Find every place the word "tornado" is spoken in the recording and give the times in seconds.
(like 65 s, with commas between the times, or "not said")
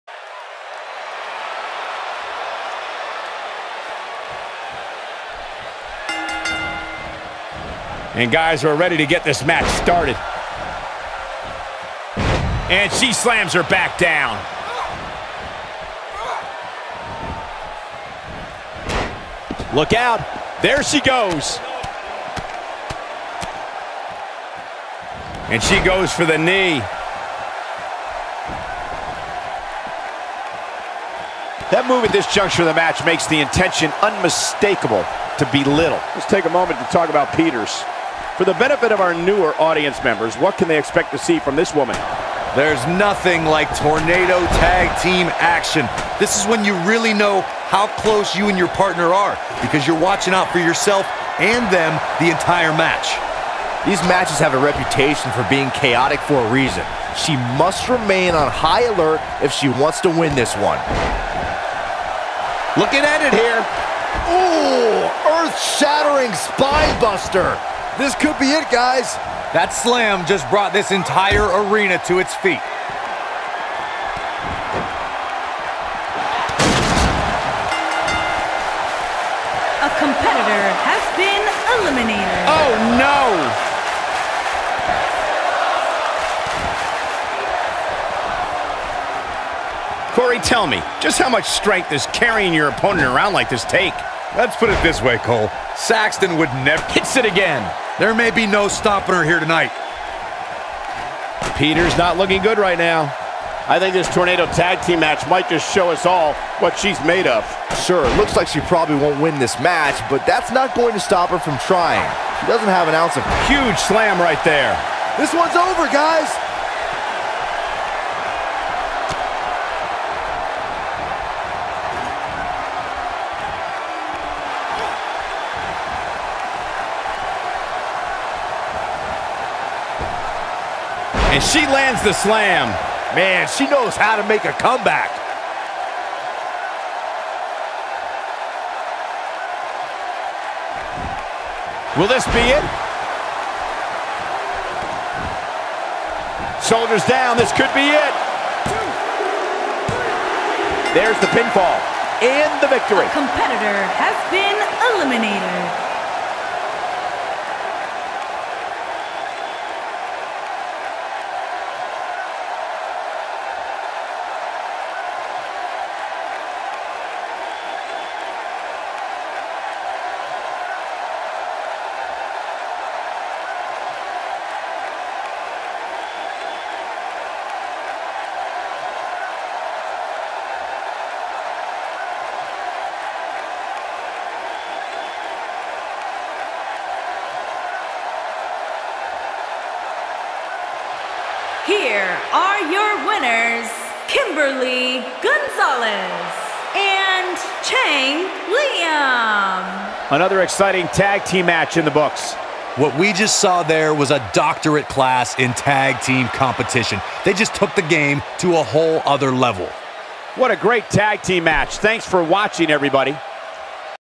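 43 s, 104 s.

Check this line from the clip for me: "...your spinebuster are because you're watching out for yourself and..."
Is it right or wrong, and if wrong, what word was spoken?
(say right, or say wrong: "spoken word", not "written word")
wrong: "partner", not "spinebuster".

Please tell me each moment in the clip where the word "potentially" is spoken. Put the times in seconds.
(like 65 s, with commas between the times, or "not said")
not said.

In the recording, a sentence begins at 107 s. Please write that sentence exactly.
Sure, looks like she probably won't win this match, but that's not going to stop her from trying.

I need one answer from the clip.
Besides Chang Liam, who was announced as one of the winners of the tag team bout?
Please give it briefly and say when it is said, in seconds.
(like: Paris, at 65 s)
Kimberly Gonzalez, at 194 s.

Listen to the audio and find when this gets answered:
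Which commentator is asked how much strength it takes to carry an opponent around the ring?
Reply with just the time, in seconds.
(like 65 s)
90 s.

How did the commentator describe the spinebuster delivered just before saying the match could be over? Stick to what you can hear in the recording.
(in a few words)
Earth-shattering.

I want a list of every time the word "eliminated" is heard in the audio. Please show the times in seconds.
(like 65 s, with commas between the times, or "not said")
81 s, 154 s.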